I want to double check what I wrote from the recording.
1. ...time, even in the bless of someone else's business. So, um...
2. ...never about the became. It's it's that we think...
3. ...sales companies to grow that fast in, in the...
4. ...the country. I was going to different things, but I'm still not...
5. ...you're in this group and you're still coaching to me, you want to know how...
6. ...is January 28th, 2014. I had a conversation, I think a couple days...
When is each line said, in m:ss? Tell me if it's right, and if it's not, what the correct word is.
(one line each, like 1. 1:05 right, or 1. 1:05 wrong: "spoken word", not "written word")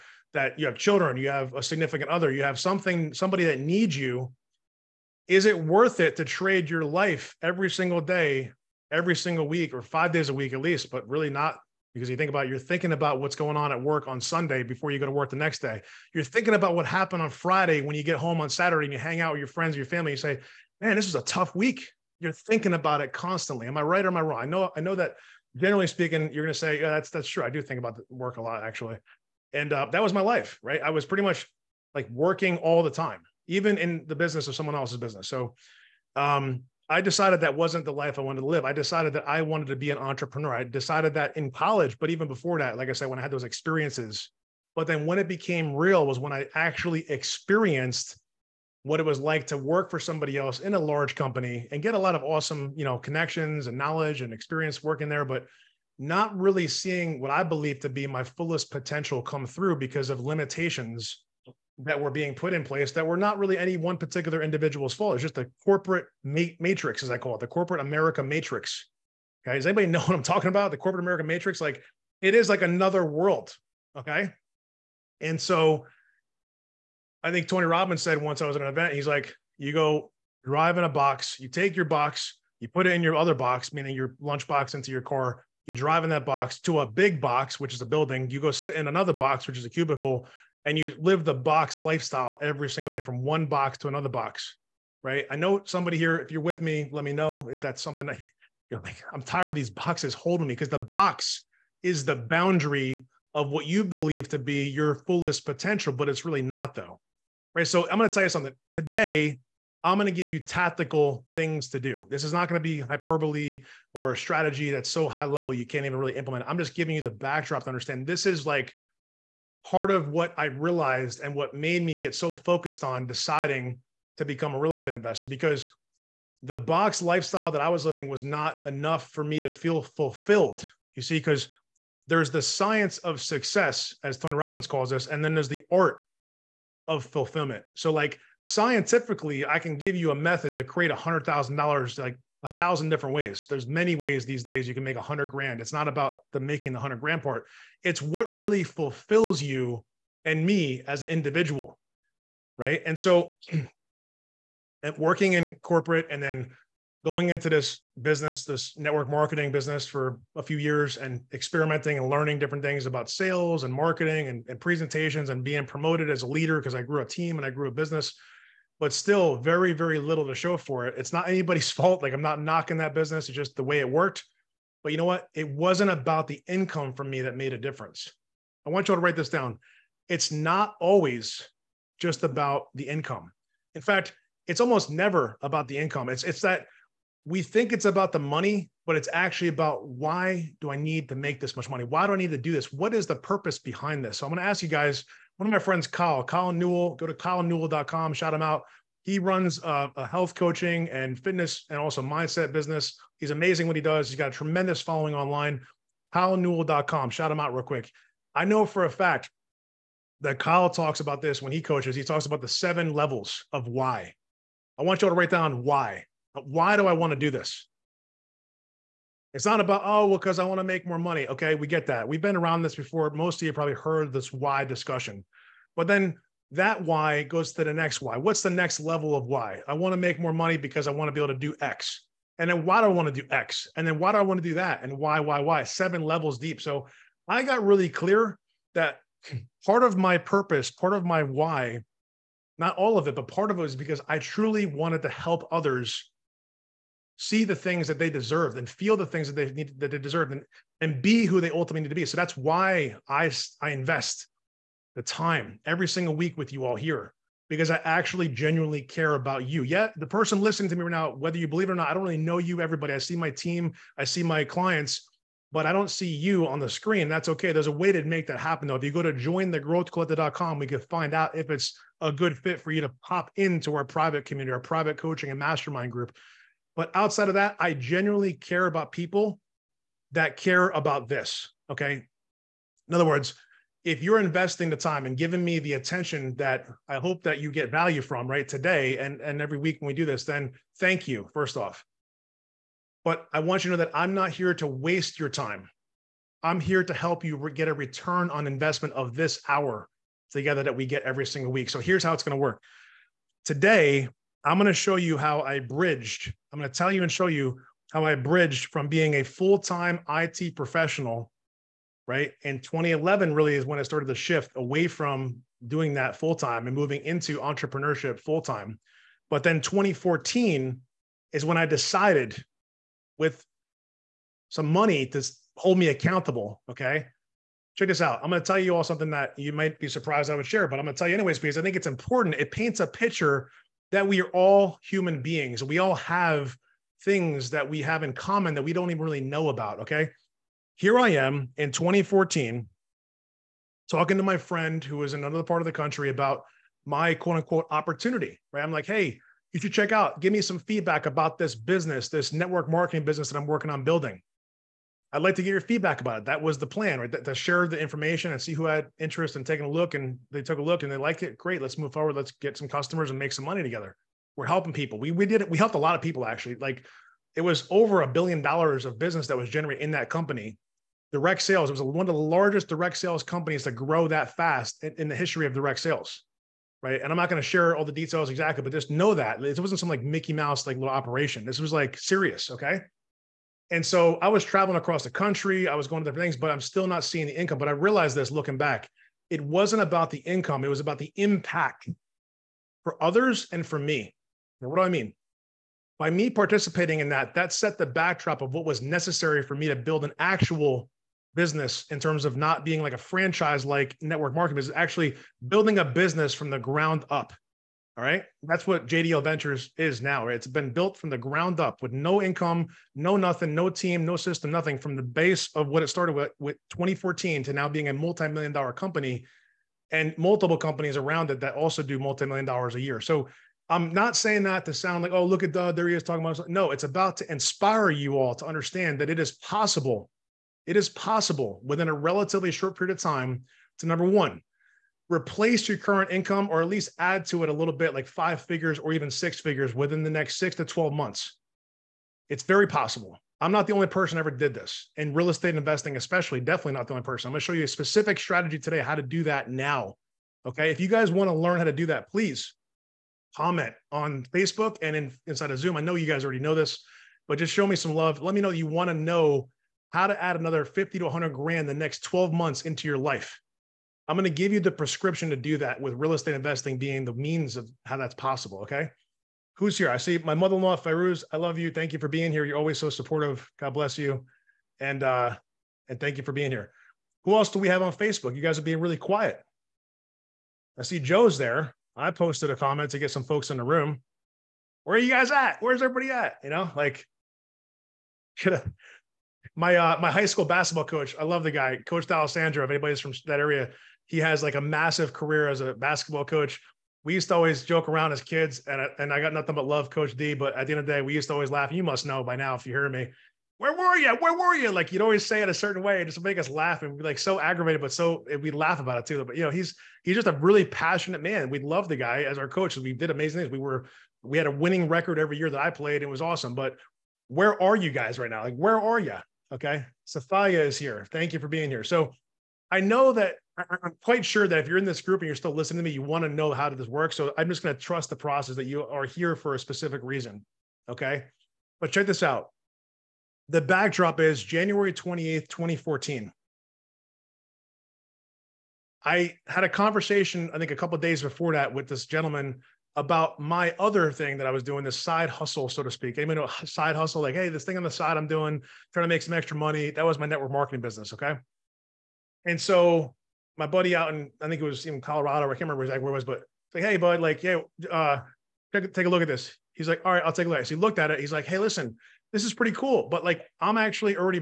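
1. 0:32 wrong: "business", not "bless"
2. 3:04 wrong: "income", not "became"
3. 6:12 right
4. 6:25 right
5. 8:44 wrong: "listening", not "coaching"
6. 8:54 right.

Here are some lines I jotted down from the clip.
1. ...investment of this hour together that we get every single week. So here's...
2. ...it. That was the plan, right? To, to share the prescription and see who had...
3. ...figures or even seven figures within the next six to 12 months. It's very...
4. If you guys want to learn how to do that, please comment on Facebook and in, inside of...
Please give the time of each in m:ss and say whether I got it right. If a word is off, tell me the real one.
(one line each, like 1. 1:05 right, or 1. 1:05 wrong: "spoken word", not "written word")
1. 4:58 right
2. 5:56 wrong: "information", not "prescription"
3. 7:18 wrong: "six", not "seven"
4. 7:30 right.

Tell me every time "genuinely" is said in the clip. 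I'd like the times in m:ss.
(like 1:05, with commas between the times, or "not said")
4:18, 4:37.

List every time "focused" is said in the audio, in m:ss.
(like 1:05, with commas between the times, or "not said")
2:02.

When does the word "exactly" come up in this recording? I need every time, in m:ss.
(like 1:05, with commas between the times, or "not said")
6:18, 9:15.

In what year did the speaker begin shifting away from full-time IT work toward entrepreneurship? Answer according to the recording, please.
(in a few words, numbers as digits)
2011.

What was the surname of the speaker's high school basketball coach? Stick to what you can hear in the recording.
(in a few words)
D'Alessandro.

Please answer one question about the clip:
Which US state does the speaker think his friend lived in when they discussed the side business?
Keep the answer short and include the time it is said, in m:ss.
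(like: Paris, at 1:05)
Colorado, at 9:15.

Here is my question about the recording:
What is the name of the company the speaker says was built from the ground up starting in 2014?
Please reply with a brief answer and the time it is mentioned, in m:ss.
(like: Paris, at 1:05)
JDL Ventures, at 6:48.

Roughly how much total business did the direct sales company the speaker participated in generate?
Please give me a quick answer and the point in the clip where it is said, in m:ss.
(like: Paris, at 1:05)
over a billion dollars, at 6:07.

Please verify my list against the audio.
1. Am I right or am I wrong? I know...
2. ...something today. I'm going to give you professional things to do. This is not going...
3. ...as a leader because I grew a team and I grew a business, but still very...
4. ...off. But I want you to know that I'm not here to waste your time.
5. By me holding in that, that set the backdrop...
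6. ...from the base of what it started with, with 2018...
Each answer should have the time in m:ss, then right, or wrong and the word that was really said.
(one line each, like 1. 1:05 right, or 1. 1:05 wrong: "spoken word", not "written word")
1. 0:23 right
2. 1:48 wrong: "tactical", not "professional"
3. 2:46 right
4. 4:51 right
5. 6:35 wrong: "participating", not "holding"
6. 6:54 wrong: "2014", not "2018".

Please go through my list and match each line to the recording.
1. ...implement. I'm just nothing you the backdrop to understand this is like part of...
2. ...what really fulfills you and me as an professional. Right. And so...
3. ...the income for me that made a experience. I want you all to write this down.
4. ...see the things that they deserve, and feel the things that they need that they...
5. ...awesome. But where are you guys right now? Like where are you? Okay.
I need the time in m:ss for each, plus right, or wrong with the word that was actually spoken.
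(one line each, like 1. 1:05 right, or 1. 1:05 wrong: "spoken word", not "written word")
1. 1:56 wrong: "giving", not "nothing"
2. 2:28 wrong: "individual", not "professional"
3. 2:56 wrong: "difference", not "experience"
4. 4:07 right
5. 8:36 right.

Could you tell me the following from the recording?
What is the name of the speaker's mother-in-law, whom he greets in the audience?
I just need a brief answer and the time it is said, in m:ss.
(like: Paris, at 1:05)
Fairuz, at 7:50.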